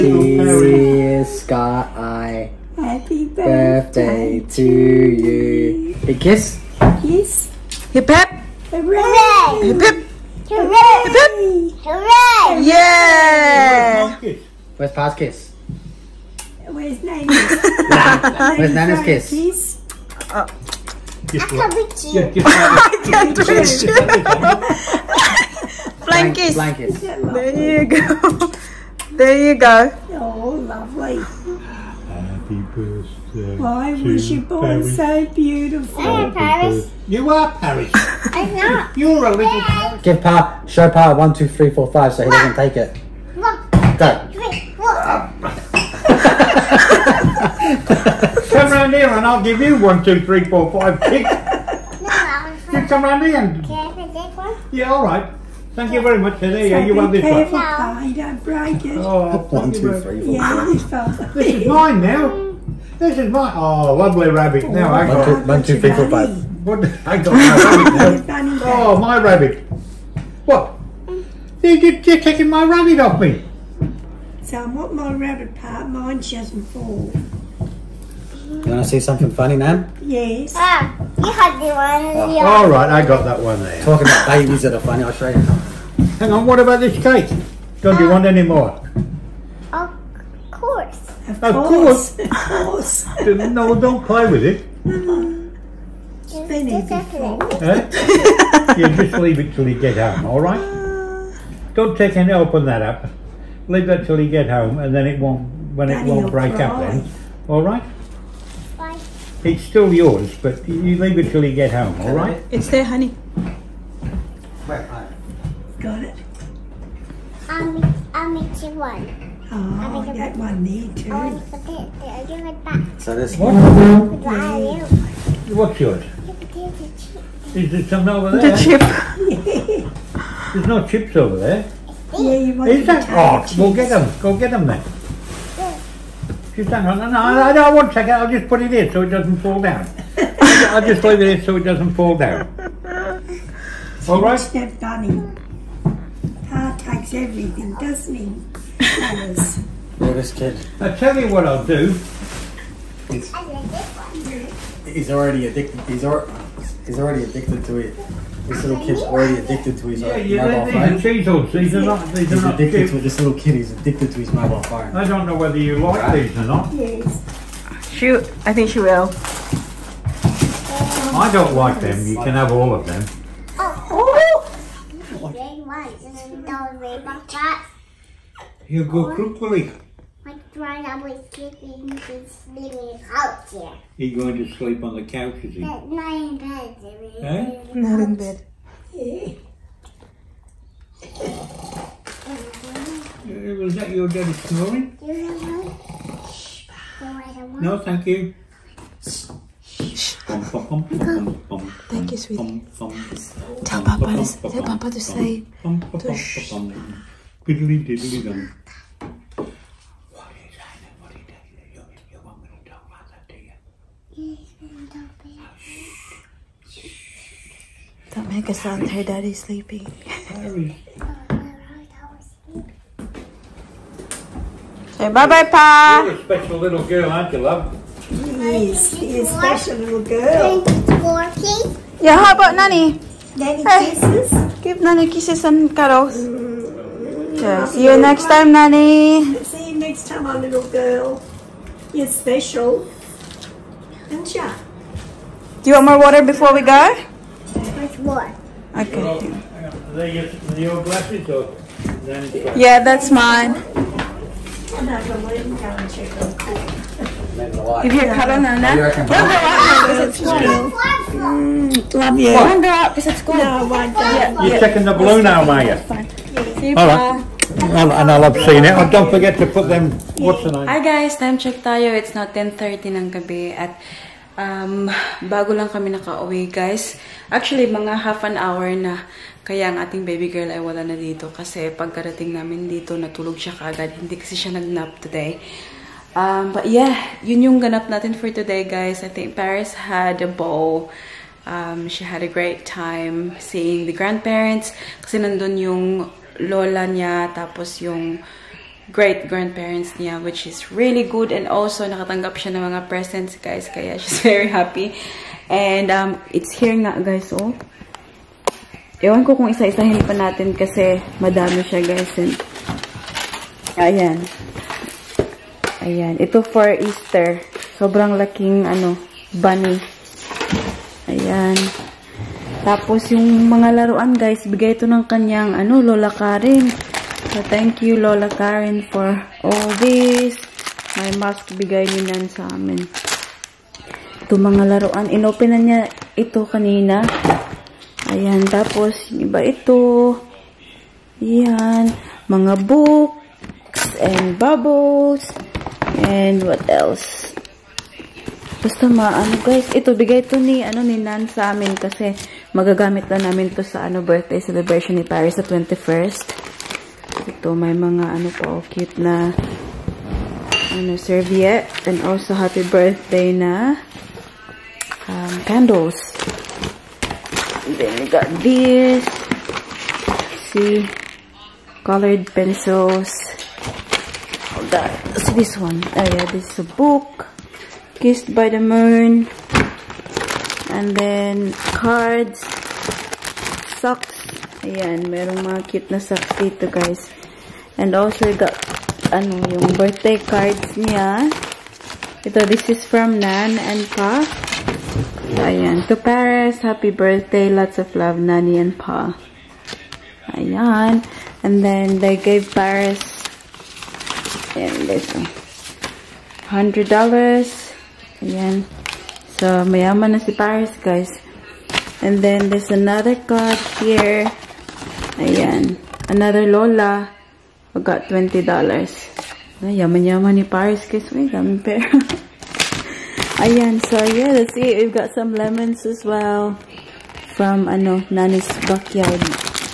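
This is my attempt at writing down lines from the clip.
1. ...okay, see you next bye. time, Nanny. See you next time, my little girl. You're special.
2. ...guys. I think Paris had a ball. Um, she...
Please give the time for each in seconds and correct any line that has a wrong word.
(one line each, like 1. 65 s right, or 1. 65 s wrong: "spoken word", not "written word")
1. 237 s right
2. 288 s right.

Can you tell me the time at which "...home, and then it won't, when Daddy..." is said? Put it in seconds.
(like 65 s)
104 s.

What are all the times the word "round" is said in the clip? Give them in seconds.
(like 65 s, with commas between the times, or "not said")
48 s, 53 s.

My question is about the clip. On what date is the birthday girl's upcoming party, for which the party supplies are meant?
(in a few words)
21st.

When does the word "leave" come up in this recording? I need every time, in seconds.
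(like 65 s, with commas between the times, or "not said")
99 s, 103 s, 110 s, 141 s.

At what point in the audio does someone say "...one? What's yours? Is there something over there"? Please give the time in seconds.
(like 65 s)
123 s.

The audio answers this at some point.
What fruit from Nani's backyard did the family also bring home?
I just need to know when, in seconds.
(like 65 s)
425 s.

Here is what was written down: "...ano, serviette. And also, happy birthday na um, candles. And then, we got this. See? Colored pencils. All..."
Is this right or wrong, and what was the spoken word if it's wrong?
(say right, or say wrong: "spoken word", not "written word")
right.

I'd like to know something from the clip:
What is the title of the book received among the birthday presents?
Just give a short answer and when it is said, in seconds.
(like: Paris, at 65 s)
Kissed by the Moon, at 378 s.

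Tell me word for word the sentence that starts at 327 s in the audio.
So, thank you, Lola Karen, for all this.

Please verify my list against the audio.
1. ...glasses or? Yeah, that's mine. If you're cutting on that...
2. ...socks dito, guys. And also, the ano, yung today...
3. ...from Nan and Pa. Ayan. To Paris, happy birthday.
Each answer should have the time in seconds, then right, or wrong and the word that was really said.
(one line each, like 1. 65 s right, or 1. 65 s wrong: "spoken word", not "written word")
1. 250 s right
2. 386 s wrong: "birthday", not "today"
3. 392 s right.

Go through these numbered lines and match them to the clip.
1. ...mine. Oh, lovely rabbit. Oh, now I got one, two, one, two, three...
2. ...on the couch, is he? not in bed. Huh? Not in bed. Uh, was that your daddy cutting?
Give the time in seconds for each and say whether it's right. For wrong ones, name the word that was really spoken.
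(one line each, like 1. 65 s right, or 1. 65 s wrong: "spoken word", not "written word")
1. 63 s right
2. 184 s wrong: "snoring", not "cutting".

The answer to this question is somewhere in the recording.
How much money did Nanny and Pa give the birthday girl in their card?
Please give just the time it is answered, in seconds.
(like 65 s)
406 s.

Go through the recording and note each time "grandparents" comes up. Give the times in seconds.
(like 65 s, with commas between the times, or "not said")
293 s, 298 s.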